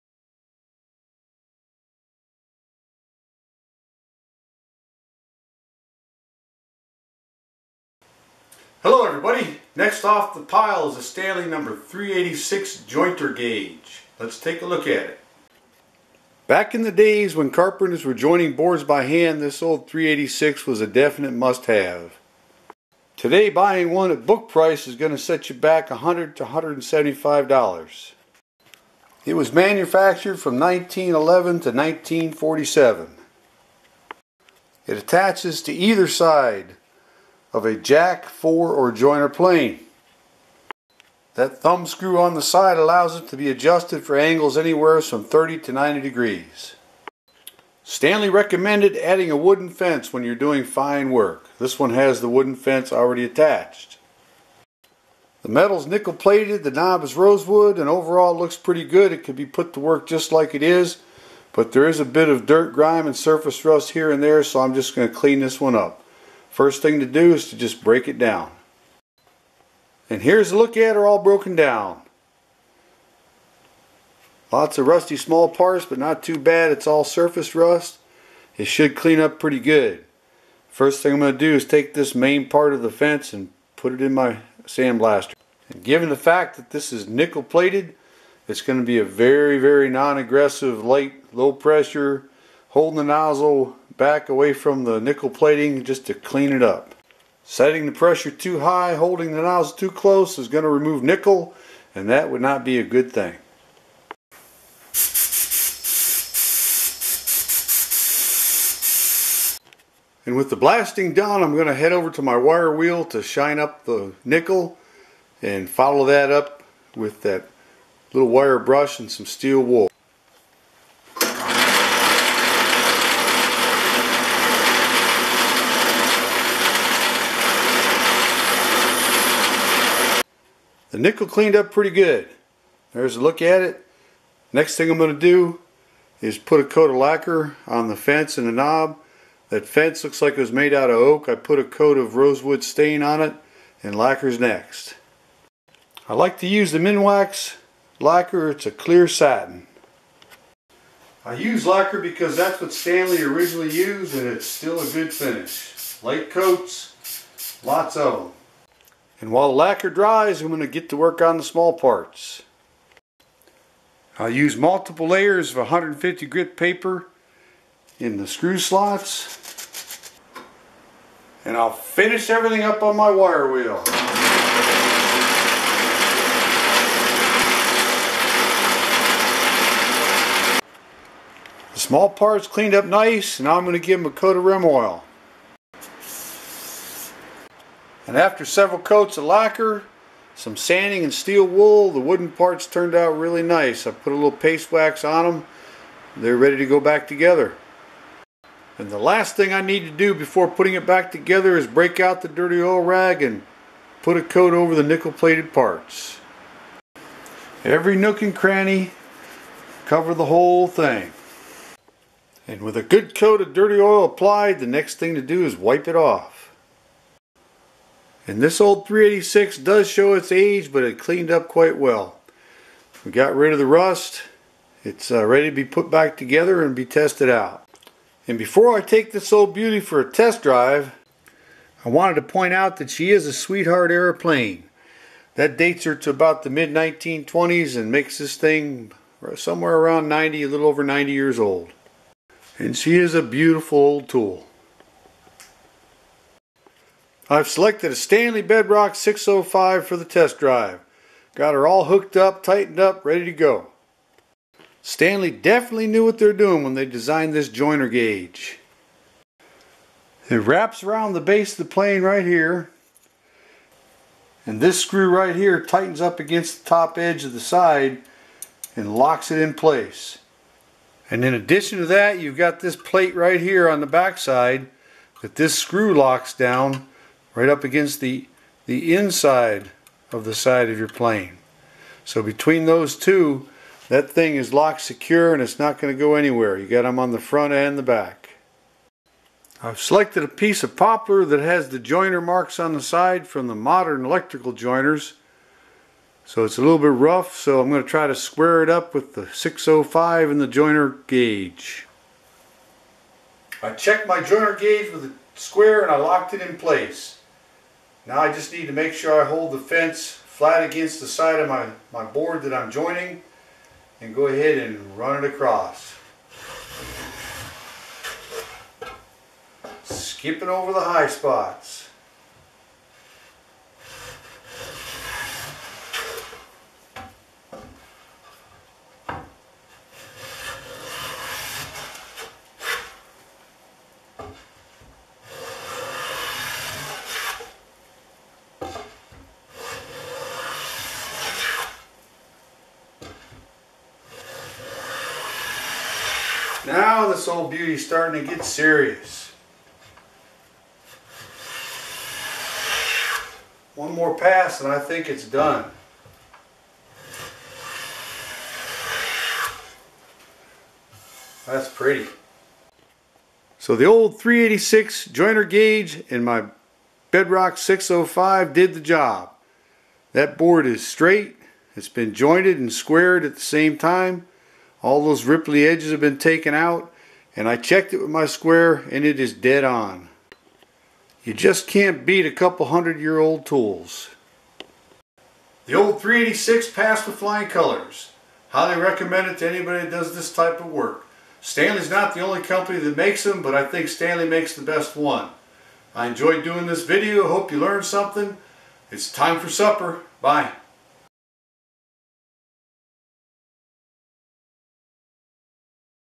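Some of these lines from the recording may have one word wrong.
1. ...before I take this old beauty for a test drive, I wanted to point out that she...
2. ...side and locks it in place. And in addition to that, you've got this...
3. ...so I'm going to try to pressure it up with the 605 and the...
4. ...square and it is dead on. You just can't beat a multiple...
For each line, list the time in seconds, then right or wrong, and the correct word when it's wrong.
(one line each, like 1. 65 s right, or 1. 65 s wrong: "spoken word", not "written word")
1. 228 s right
2. 267 s right
3. 297 s wrong: "square", not "pressure"
4. 378 s wrong: "couple", not "multiple".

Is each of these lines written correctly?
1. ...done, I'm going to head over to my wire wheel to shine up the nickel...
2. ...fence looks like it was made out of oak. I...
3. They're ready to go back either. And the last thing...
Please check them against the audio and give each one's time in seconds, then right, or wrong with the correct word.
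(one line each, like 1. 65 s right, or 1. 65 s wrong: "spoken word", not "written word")
1. 111 s right
2. 139 s right
3. 196 s wrong: "together", not "either".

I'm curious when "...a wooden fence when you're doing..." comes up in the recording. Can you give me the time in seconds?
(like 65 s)
49 s.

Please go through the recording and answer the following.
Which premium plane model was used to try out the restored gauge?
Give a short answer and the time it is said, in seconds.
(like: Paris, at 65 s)
Stanley Bedrock 605, at 247 s.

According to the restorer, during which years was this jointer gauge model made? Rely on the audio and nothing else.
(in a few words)
1911 to 1947.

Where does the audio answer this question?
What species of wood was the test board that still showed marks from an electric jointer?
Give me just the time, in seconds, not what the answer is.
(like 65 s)
290 s.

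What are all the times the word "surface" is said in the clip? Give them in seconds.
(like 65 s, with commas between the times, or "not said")
63 s, 77 s.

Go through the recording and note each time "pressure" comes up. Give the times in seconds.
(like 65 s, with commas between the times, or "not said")
91 s, 97 s.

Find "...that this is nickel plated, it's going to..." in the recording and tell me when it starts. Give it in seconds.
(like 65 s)
86 s.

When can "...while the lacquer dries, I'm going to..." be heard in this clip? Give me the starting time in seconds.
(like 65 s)
159 s.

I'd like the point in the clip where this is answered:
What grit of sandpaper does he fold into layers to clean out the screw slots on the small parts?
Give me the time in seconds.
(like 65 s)
165 s.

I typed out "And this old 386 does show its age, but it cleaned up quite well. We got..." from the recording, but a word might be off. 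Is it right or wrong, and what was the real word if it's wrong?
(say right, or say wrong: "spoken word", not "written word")
right.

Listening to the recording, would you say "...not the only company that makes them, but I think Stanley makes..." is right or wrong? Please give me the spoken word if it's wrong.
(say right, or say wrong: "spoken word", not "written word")
right.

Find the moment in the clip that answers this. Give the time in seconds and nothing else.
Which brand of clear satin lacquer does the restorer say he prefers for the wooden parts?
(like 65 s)
146 s.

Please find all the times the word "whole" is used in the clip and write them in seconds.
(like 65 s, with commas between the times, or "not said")
210 s.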